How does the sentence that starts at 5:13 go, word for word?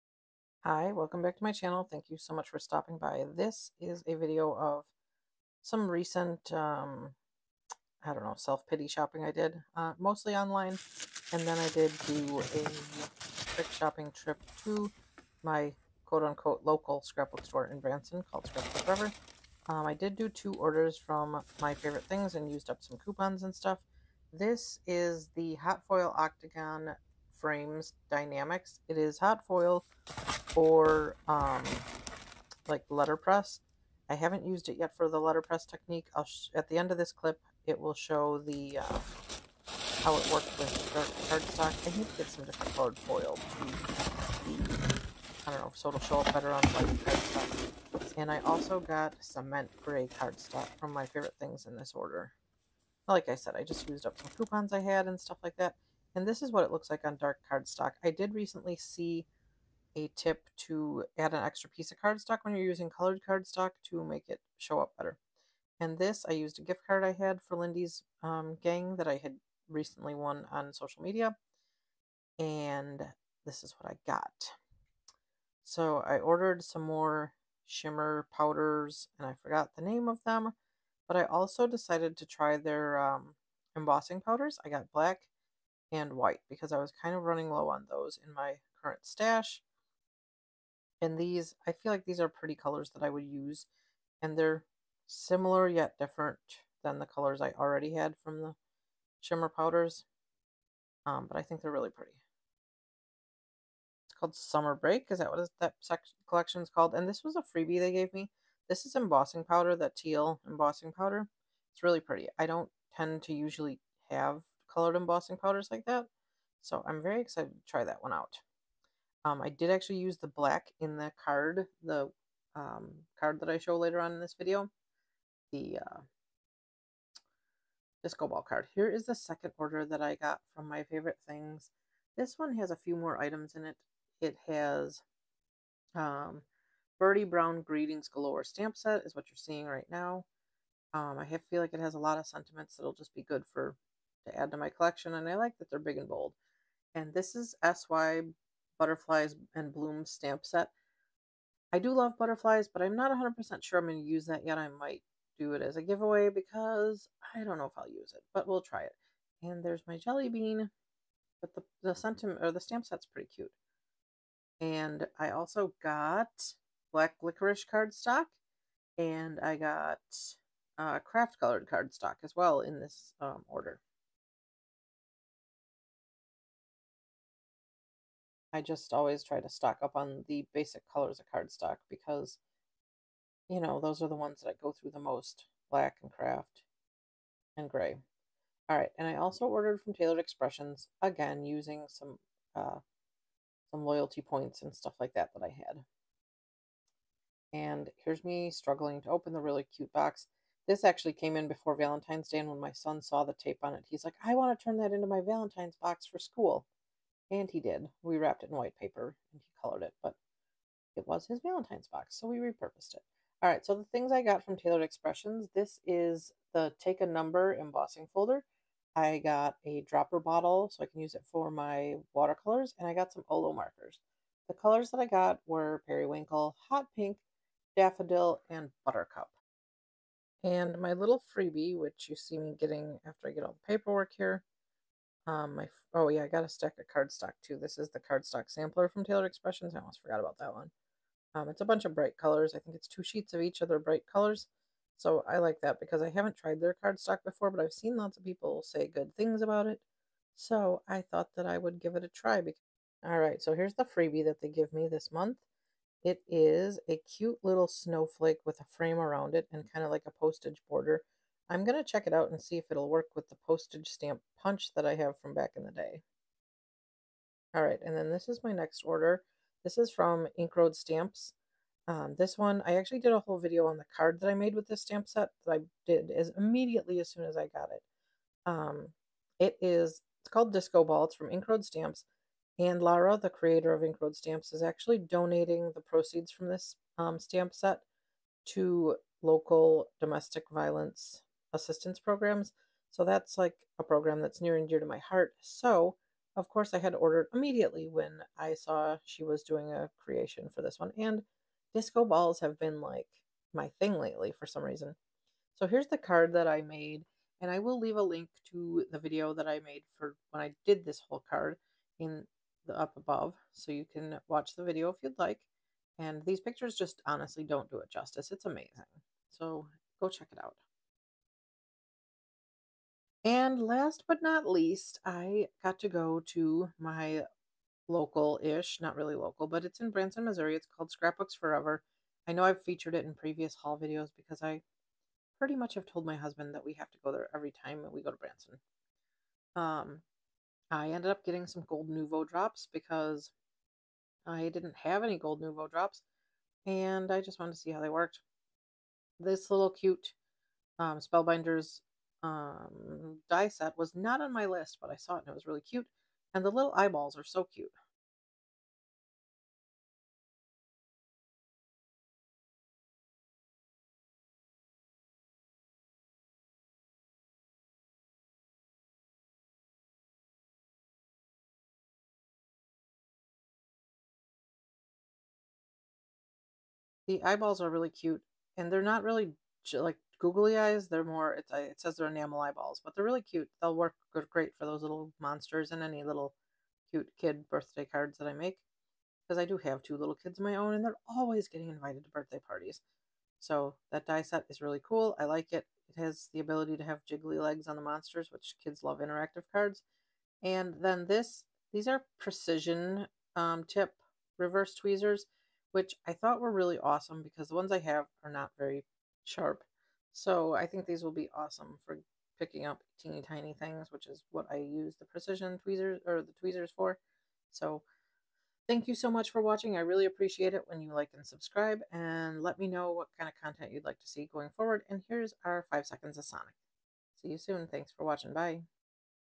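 So you can watch the video if you'd like.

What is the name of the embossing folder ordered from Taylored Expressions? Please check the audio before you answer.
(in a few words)
Take a Number.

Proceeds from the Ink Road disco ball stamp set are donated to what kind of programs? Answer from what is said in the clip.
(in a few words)
domestic violence assistance programs.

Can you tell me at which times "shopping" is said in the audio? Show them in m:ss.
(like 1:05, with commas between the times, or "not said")
0:08, 0:13.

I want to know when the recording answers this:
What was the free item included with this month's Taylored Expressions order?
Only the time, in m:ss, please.
4:17.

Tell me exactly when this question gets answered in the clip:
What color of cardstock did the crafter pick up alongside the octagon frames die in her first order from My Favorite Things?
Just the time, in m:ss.
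0:49.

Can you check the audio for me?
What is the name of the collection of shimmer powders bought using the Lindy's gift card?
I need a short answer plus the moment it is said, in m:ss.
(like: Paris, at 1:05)
Summer Break, at 1:44.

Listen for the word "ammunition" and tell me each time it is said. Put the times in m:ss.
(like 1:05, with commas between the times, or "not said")
not said.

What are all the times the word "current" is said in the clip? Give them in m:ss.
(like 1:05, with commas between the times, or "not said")
1:28.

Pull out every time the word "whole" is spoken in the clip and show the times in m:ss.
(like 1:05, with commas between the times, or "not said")
4:33, 5:11.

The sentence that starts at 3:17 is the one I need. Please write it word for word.
And here's me struggling to open the really cute box.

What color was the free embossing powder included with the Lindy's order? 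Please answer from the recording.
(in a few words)
teal.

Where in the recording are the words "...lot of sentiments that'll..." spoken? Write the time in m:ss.
2:21.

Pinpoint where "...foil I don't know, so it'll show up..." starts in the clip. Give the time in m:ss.
0:42.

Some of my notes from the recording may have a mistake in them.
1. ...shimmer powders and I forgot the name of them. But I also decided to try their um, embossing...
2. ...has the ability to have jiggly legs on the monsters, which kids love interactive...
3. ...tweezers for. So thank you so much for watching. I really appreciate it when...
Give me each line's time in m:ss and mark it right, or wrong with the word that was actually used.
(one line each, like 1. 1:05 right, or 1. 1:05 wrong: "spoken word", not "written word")
1. 1:17 right
2. 6:35 right
3. 6:56 right.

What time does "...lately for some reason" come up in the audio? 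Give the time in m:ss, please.
5:03.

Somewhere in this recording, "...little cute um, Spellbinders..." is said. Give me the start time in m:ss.
5:49.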